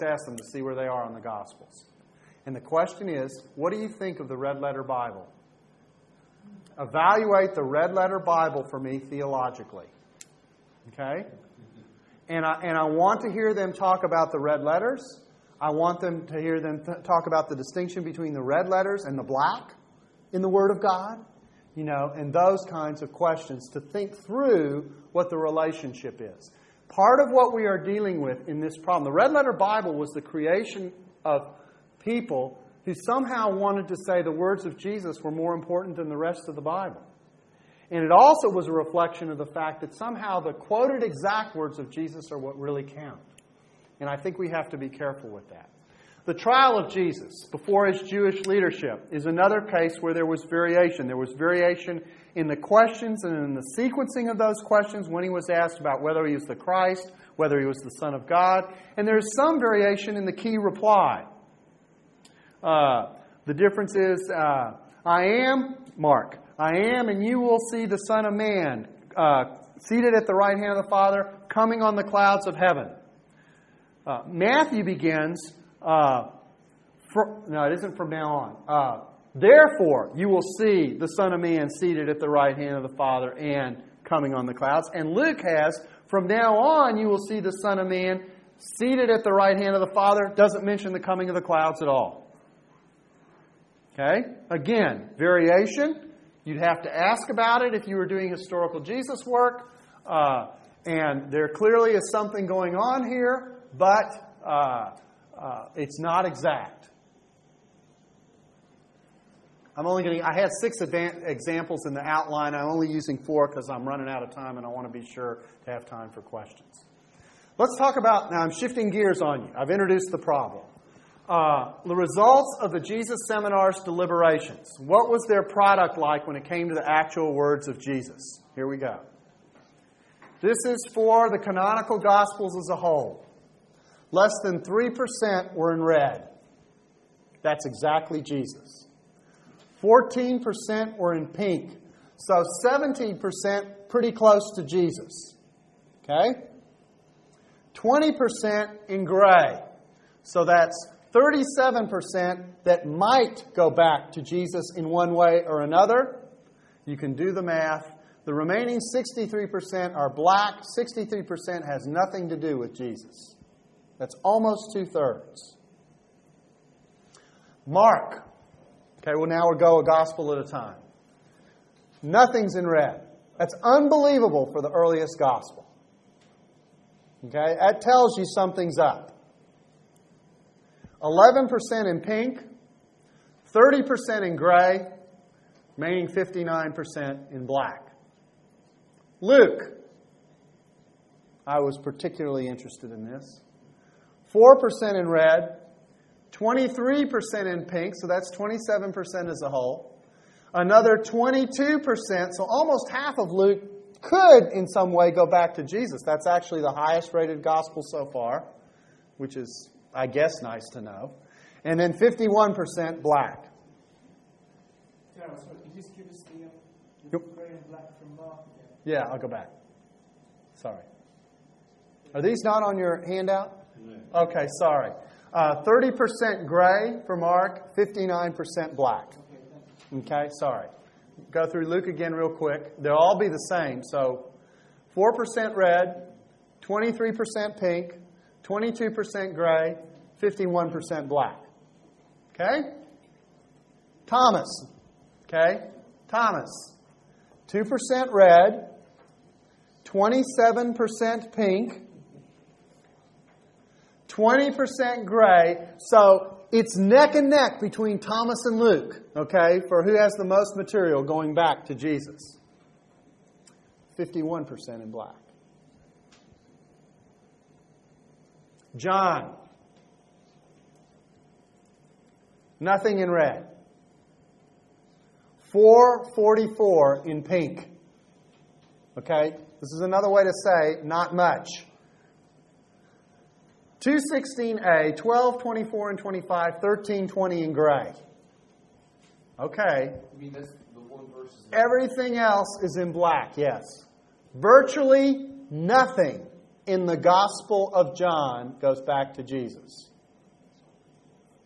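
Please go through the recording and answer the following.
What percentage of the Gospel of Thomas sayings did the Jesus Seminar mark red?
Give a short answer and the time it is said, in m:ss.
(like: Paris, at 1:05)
2%, at 4:07.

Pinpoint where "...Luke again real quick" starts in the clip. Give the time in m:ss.
3:51.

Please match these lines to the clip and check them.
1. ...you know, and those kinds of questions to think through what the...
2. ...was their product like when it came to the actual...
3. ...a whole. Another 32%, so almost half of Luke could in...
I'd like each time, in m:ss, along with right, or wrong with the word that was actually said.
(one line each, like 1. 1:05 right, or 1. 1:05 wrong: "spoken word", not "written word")
1. 0:21 right
2. 2:05 right
3. 3:19 wrong: "22", not "32".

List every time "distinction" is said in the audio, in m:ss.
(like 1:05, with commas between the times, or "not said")
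0:17.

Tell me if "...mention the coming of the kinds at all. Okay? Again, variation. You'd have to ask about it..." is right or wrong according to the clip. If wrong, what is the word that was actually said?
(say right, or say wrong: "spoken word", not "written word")
wrong: "clouds", not "kinds".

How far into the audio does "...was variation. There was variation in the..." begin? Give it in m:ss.
0:50.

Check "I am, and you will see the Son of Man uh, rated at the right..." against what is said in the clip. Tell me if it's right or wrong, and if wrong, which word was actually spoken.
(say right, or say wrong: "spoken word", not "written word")
wrong: "seated", not "rated".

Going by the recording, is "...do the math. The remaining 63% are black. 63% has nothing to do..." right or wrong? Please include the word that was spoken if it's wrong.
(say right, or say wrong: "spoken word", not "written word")
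right.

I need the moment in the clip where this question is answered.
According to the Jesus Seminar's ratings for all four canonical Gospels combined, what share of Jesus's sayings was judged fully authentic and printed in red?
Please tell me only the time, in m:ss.
2:14.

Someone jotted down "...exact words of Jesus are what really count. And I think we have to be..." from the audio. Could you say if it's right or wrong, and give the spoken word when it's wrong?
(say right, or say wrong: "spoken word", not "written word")
right.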